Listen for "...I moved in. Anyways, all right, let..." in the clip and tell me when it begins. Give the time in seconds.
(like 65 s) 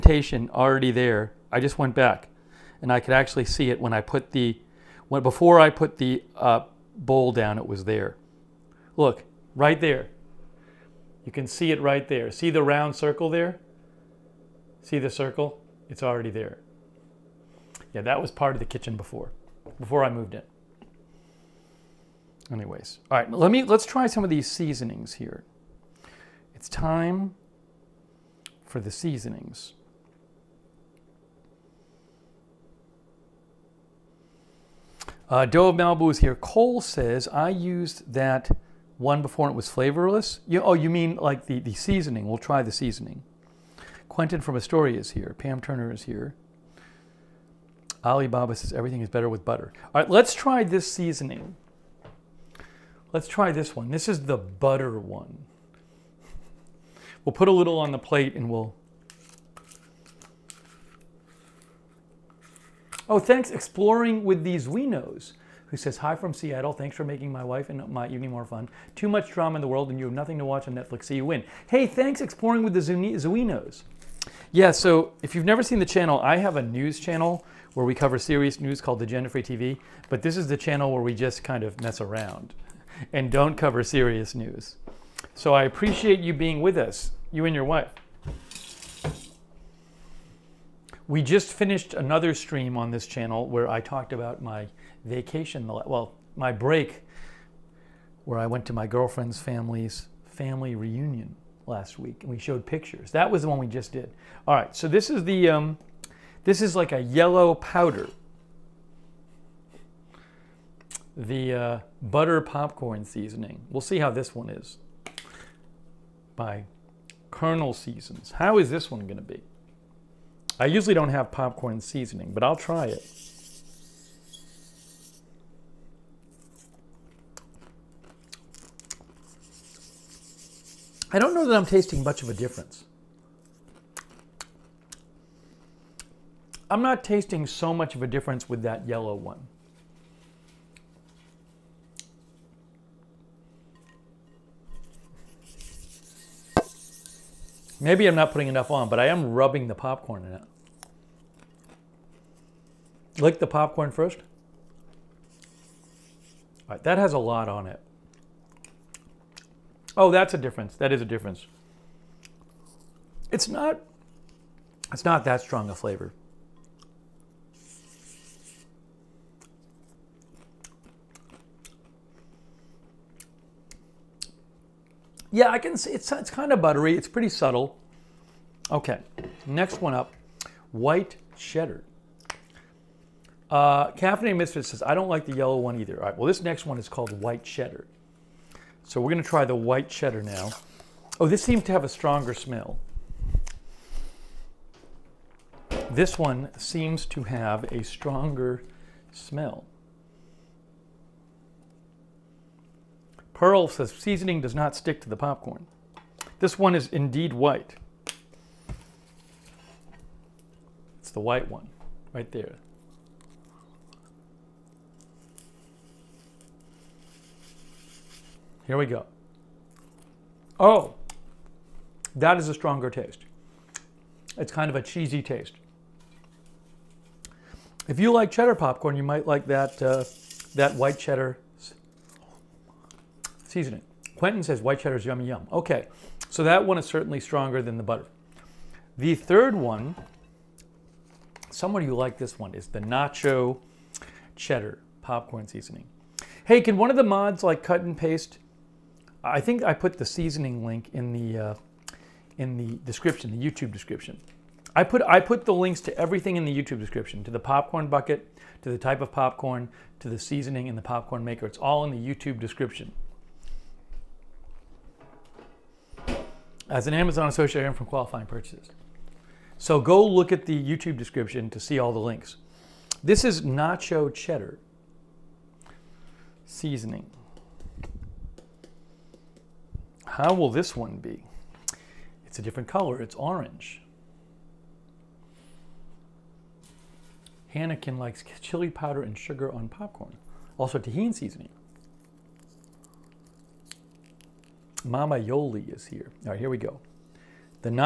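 20 s.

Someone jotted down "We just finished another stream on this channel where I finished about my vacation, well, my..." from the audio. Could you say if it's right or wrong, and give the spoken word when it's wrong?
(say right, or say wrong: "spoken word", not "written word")
wrong: "talked", not "finished".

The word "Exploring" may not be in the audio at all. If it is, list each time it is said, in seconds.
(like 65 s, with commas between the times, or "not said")
63 s, 72 s.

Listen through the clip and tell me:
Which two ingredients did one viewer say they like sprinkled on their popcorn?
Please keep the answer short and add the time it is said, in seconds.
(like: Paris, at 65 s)
chili powder and sugar, at 288 s.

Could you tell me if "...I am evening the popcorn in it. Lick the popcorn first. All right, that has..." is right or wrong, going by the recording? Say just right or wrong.
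wrong.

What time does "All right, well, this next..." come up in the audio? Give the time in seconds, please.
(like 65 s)
185 s.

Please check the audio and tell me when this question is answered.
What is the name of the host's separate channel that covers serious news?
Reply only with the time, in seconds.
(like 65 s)
79 s.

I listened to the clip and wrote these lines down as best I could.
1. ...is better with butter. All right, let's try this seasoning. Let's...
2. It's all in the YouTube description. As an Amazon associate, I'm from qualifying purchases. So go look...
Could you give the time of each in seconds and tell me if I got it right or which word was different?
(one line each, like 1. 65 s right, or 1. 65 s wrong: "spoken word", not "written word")
1. 48 s right
2. 261 s right.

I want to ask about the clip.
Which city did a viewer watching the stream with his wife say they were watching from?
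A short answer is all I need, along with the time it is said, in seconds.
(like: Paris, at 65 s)
Seattle, at 66 s.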